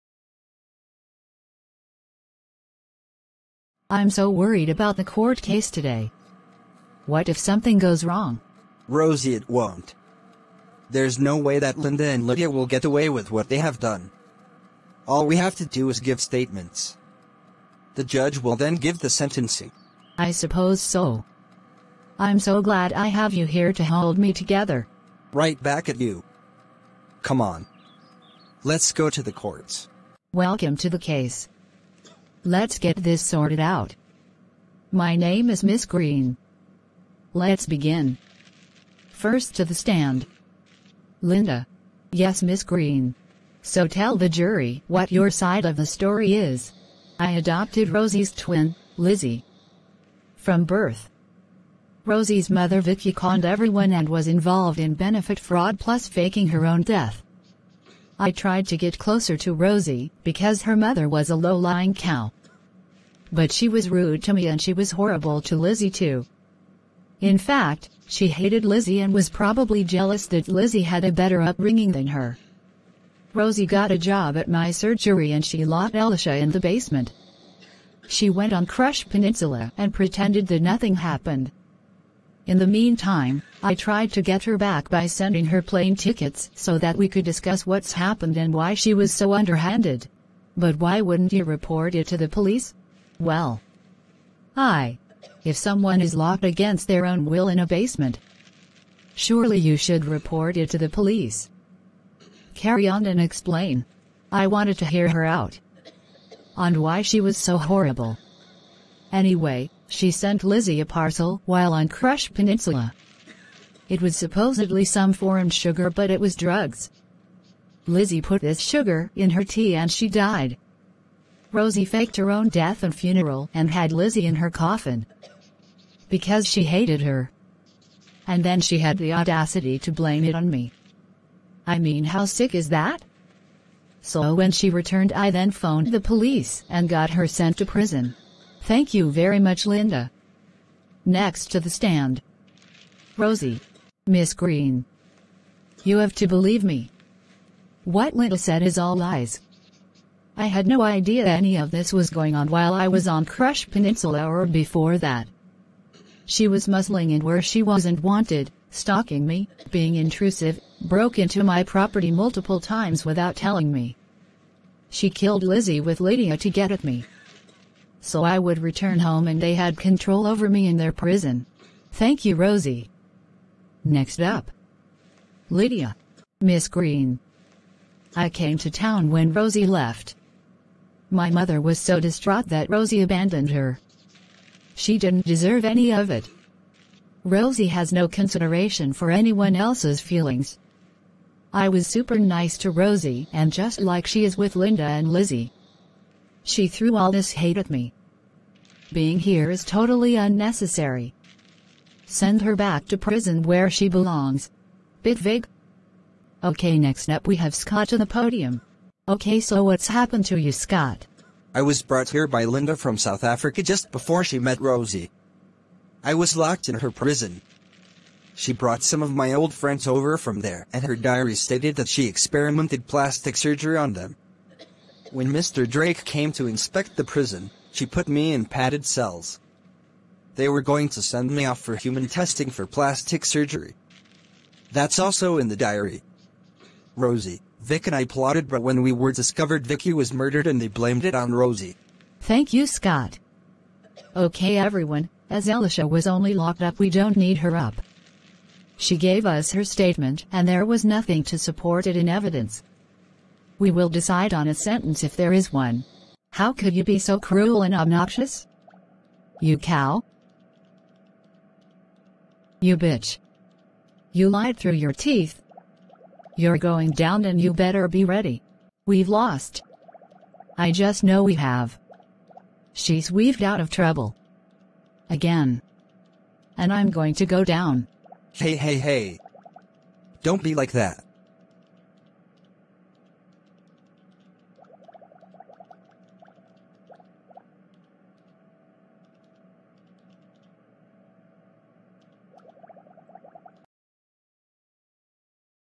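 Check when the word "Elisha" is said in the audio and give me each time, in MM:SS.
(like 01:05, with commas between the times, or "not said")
01:15, 04:05.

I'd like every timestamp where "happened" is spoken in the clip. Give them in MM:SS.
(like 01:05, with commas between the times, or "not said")
01:20, 01:27, 03:29.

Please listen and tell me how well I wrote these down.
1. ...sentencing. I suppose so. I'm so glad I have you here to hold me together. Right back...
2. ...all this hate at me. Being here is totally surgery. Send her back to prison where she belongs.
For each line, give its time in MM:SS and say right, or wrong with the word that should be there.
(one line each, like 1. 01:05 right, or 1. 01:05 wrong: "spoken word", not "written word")
1. 00:19 right
2. 03:16 wrong: "unnecessary", not "surgery".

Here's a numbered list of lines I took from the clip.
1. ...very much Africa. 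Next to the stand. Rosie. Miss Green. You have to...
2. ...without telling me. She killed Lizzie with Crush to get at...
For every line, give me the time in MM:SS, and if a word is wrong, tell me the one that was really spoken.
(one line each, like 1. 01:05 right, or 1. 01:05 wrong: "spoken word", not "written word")
1. 02:19 wrong: "Linda", not "Africa"
2. 02:43 wrong: "Lydia", not "Crush".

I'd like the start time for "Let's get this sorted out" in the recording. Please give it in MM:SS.
00:32.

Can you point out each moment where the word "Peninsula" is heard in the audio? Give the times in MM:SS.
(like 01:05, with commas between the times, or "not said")
01:19, 01:52, 02:33.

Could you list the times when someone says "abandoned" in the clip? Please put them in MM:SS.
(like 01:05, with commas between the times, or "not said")
03:03.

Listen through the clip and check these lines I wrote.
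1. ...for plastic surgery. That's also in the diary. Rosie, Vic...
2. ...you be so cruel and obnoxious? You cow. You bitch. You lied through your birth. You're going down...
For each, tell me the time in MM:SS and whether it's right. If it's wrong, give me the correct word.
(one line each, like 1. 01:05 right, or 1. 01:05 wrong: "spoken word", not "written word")
1. 03:52 right
2. 04:16 wrong: "teeth", not "birth".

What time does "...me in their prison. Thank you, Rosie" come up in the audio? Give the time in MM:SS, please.
02:50.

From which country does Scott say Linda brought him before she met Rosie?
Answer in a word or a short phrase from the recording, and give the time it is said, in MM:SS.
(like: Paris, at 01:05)
South Africa, at 03:32.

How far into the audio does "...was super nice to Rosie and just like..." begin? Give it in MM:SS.
03:11.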